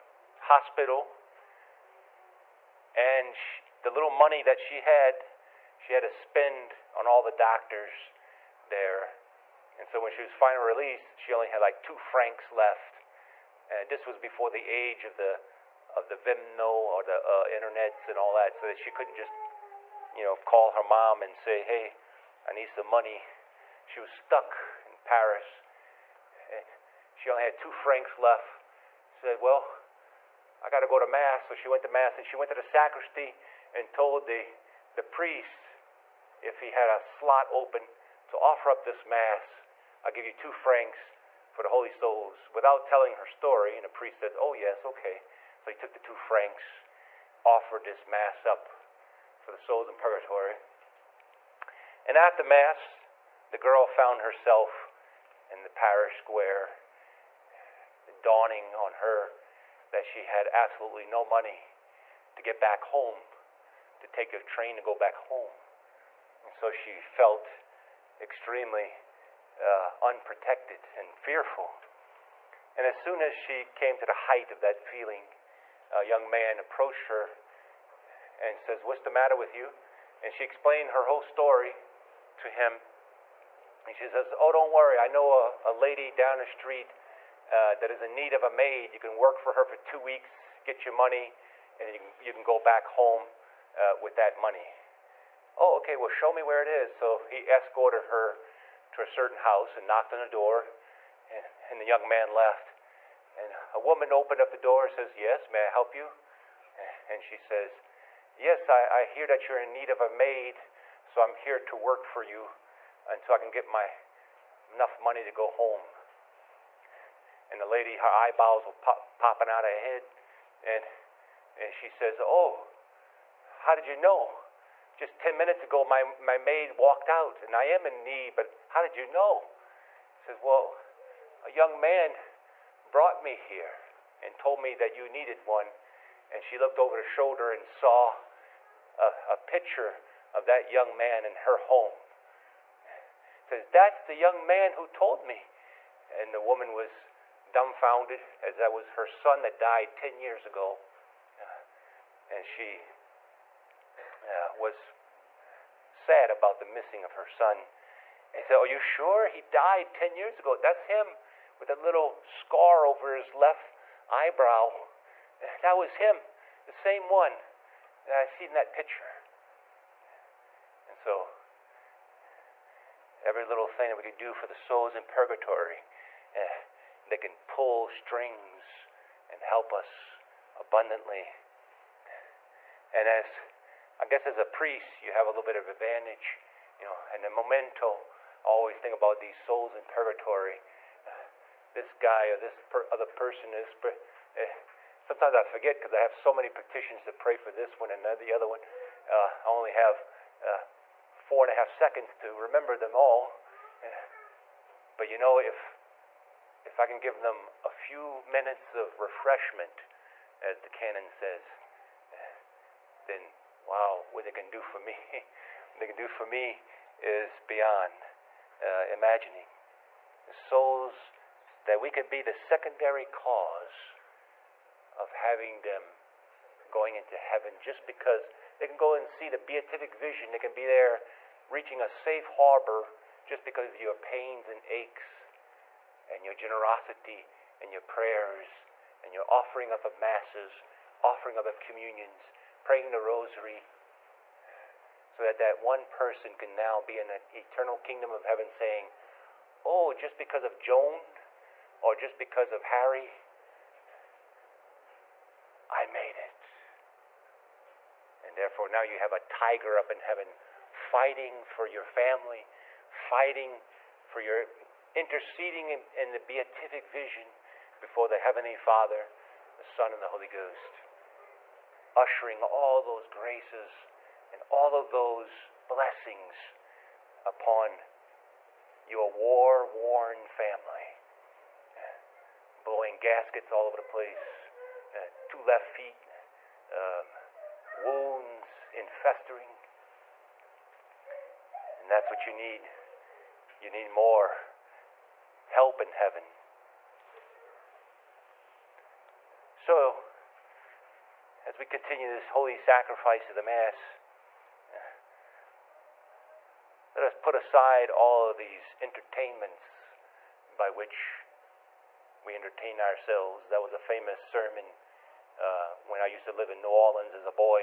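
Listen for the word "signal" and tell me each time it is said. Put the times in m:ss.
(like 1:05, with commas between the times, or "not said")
not said.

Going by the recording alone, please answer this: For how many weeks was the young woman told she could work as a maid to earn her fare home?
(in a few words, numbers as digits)
2 weeks.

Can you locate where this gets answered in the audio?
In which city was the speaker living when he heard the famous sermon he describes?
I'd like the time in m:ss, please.
5:16.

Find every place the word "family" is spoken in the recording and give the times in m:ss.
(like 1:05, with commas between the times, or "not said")
4:21, 4:40.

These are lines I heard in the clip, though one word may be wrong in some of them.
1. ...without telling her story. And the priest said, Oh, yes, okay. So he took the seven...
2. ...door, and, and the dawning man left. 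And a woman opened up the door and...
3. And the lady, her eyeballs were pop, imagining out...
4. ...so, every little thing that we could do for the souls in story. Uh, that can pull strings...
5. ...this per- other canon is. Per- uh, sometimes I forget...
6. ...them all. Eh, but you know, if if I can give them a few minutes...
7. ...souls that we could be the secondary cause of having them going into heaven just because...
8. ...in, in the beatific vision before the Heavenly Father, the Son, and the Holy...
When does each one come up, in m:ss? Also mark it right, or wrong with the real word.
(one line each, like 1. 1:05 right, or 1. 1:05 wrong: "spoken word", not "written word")
1. 0:42 wrong: "two", not "seven"
2. 1:40 wrong: "young", not "dawning"
3. 1:57 wrong: "popping", not "imagining"
4. 2:50 wrong: "purgatory", not "story"
5. 3:12 wrong: "person", not "canon"
6. 3:22 right
7. 3:40 right
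8. 4:25 right.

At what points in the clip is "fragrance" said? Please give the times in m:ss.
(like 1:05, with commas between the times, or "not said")
not said.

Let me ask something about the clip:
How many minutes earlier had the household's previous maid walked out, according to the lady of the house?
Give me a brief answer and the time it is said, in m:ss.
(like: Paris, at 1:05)
10 minutes, at 2:05.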